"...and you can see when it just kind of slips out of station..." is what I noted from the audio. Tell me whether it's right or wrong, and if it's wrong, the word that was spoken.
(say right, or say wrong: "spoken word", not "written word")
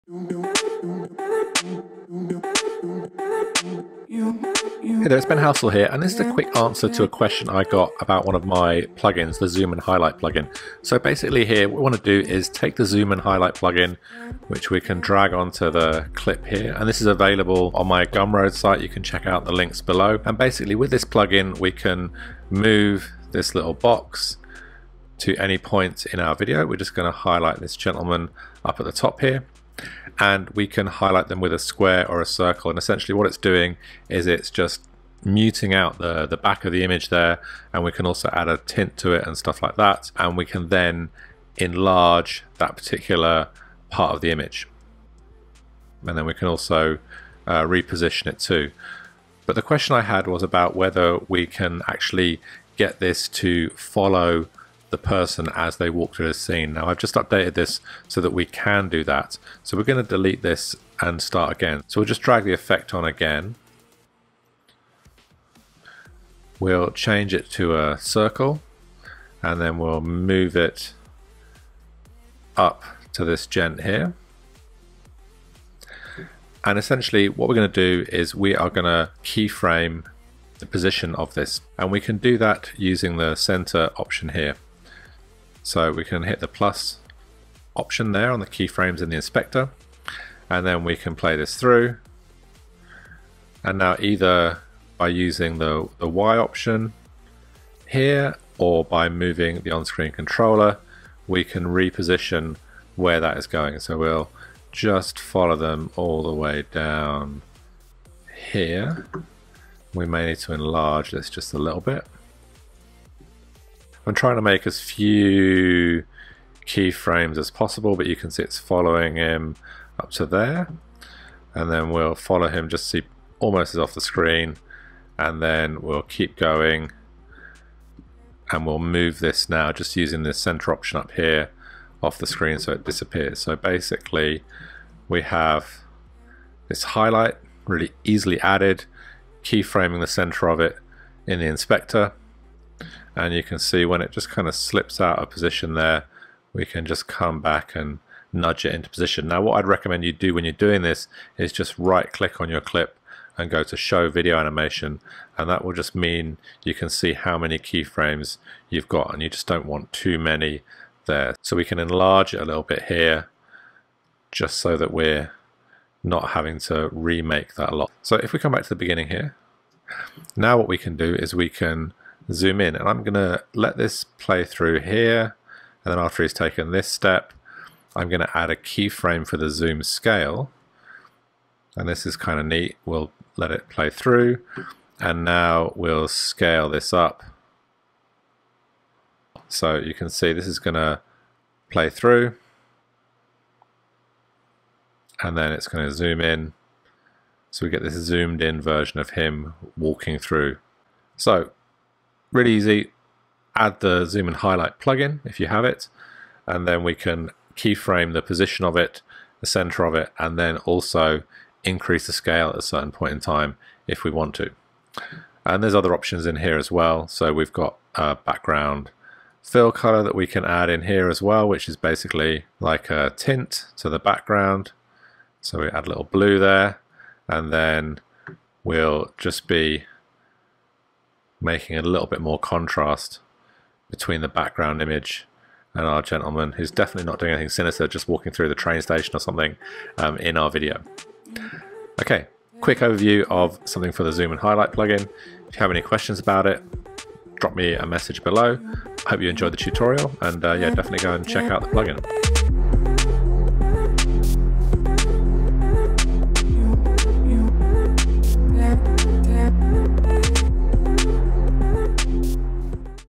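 wrong: "position", not "station".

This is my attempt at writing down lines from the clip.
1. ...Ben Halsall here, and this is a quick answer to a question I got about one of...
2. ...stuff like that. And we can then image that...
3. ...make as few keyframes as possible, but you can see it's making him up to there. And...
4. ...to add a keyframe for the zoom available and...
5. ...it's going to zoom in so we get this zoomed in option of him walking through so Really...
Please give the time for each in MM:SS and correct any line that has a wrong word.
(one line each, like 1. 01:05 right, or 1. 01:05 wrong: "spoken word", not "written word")
1. 00:05 right
2. 00:39 wrong: "enlarge", not "image"
3. 01:54 wrong: "following", not "making"
4. 02:58 wrong: "scale", not "available"
5. 03:15 wrong: "version", not "option".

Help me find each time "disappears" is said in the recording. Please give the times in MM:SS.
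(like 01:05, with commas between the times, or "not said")
02:12.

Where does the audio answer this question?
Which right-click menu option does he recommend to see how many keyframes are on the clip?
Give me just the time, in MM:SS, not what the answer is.
02:33.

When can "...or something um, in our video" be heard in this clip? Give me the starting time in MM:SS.
03:59.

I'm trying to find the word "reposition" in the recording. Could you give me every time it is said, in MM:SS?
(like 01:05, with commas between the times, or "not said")
00:47, 01:41.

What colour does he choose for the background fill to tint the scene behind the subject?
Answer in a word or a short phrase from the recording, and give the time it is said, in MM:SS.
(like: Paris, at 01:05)
Blue, at 03:46.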